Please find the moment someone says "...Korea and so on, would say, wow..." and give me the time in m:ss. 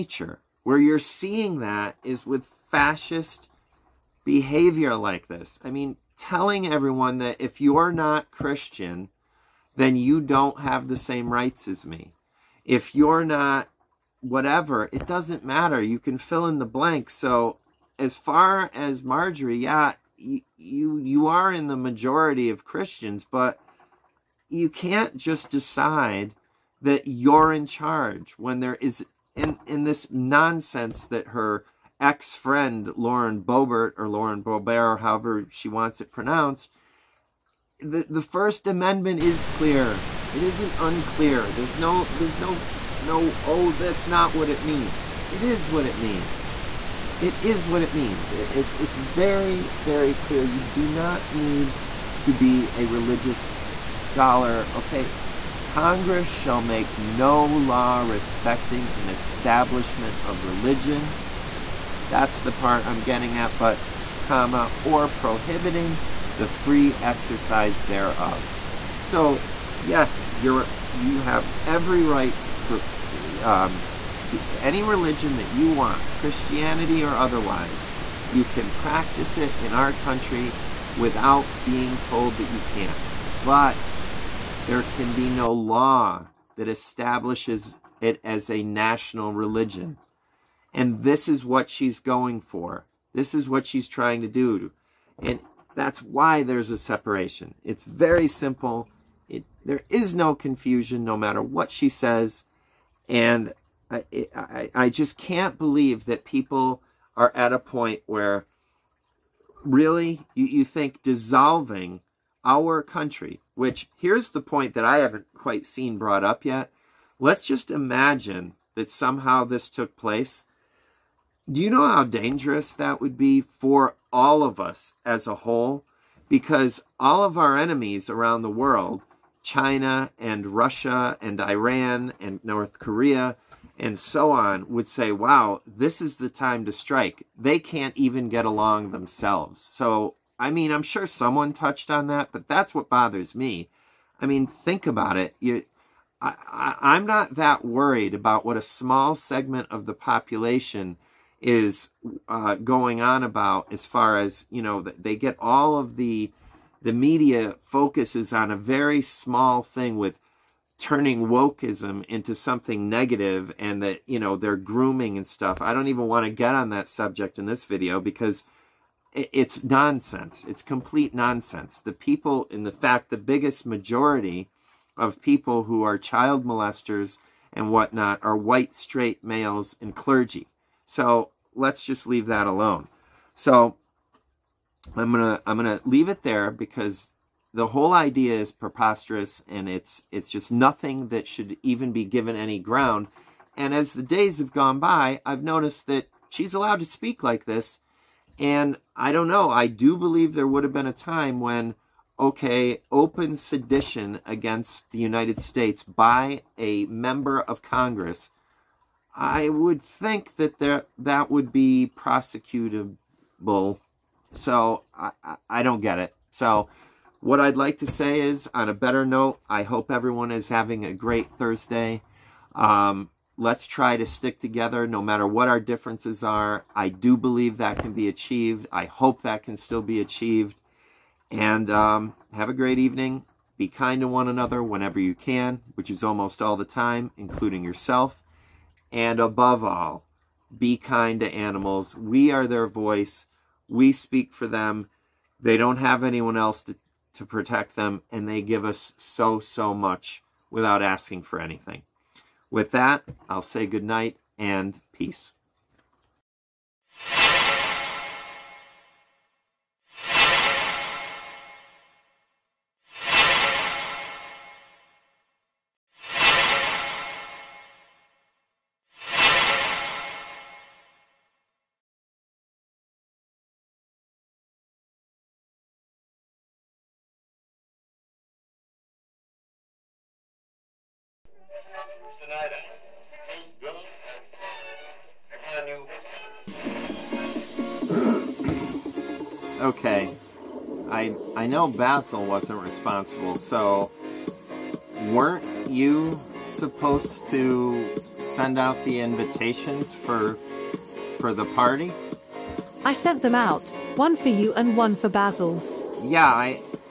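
2:12.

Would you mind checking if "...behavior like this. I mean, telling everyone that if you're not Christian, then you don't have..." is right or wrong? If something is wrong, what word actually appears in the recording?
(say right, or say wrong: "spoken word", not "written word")
right.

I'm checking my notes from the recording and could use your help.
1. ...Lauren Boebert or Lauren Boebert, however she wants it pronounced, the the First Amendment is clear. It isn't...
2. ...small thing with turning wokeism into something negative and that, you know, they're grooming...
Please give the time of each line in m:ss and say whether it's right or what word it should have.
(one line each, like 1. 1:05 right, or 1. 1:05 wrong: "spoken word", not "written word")
1. 0:32 right
2. 2:39 right.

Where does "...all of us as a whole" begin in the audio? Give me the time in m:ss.
2:04.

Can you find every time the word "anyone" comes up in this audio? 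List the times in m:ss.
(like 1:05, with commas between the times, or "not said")
4:06.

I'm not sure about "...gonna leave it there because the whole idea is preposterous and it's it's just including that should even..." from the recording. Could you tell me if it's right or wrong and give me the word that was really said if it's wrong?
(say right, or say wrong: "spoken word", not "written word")
wrong: "nothing", not "including".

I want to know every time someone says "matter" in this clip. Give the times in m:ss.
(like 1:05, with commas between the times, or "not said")
0:15, 1:41, 3:45.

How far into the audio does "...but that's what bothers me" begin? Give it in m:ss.
2:22.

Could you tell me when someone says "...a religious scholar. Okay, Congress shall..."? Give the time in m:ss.
0:52.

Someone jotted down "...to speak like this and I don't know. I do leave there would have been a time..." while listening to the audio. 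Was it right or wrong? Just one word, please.
wrong.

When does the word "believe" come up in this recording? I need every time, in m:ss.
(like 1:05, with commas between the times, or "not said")
1:45, 3:19, 3:47.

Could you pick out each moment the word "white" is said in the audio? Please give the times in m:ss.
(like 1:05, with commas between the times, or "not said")
2:58.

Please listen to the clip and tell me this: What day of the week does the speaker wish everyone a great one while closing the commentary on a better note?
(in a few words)
Thursday.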